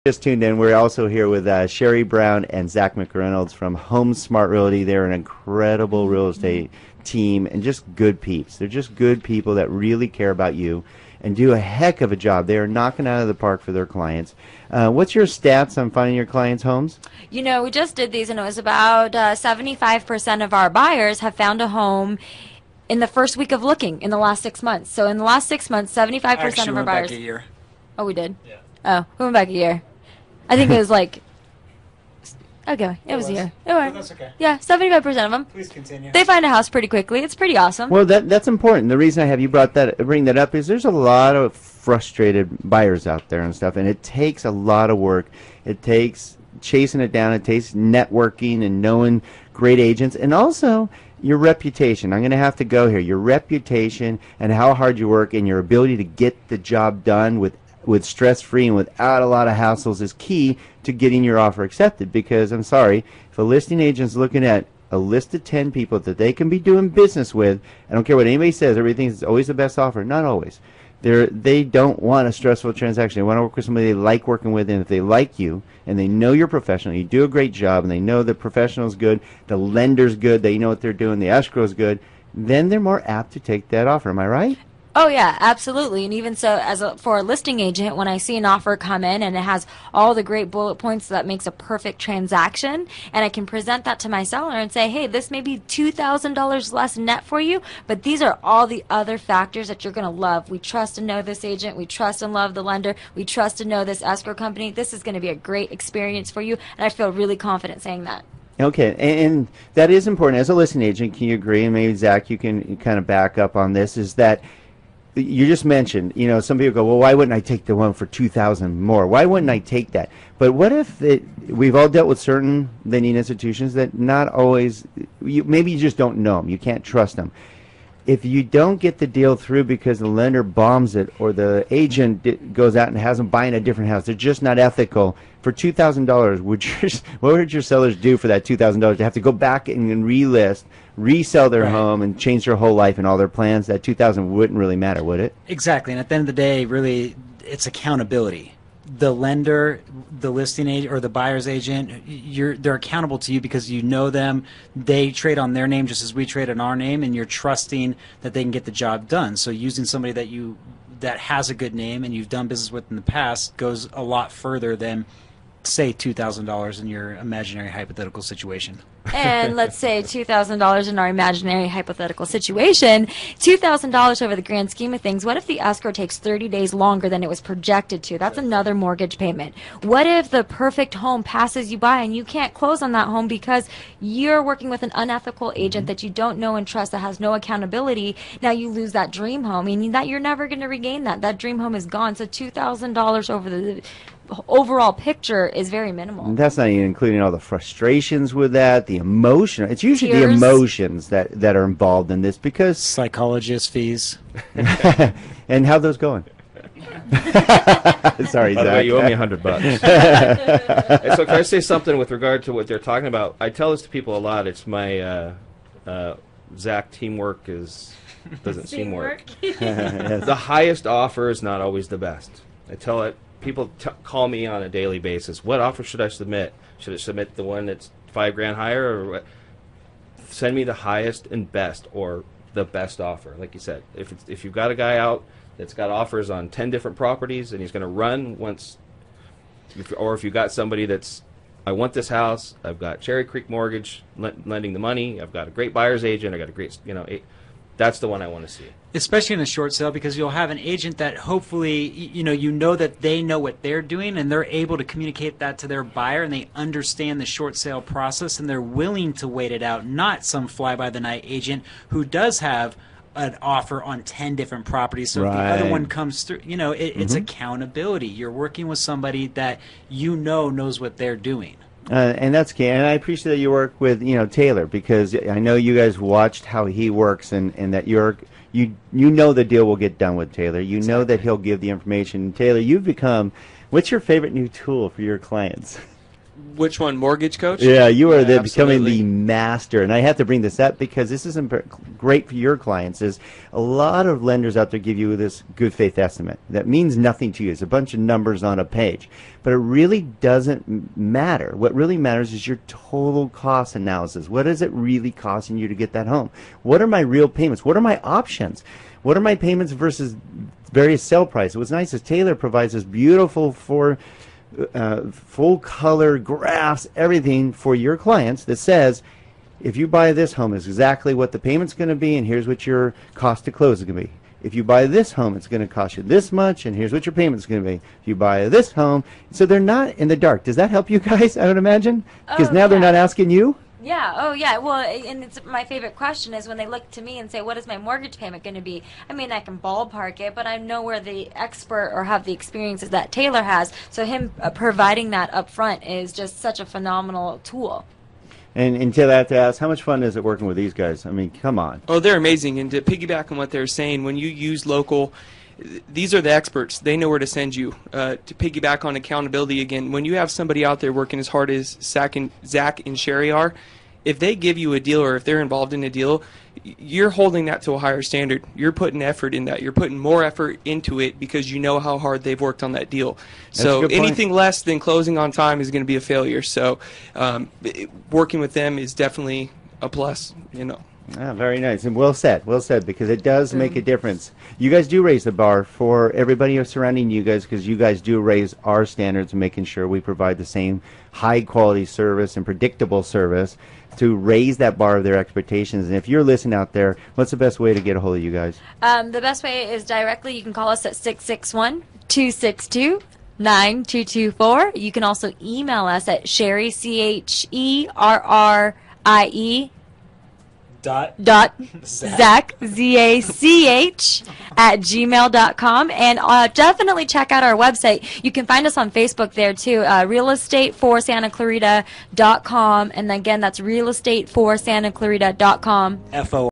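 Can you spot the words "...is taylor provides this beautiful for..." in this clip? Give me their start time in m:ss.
5:11.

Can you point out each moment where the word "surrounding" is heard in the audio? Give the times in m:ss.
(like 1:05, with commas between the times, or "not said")
6:26.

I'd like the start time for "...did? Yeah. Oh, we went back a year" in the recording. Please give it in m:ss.
0:28.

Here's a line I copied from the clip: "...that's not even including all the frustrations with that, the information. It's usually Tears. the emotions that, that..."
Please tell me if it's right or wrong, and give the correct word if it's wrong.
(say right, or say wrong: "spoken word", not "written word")
wrong: "emotion", not "information".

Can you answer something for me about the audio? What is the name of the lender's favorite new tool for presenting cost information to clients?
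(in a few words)
Mortgage Coach.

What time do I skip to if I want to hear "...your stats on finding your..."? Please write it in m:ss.
0:15.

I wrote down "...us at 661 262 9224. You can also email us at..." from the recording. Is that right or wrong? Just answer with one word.
right.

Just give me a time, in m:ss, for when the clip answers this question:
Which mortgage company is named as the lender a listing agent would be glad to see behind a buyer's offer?
4:03.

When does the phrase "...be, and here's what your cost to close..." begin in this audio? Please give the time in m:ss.
5:21.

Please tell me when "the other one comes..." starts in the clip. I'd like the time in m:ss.
4:25.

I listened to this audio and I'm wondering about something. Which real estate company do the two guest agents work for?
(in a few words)
HomeSmart Realty.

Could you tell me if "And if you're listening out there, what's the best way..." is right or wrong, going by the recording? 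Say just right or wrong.
right.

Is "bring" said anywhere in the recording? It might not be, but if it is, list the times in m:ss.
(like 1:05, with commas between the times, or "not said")
0:39, 4:50.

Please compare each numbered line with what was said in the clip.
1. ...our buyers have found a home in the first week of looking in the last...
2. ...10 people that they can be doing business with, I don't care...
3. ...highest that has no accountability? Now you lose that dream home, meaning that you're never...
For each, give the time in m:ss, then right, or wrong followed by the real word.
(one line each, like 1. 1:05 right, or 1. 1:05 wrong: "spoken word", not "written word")
1. 0:20 right
2. 1:05 right
3. 3:06 wrong: "trust", not "highest".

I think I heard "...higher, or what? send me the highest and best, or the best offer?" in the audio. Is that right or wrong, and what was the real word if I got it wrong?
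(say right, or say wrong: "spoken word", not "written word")
right.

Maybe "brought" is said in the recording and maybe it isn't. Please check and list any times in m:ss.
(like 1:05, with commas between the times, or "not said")
0:39.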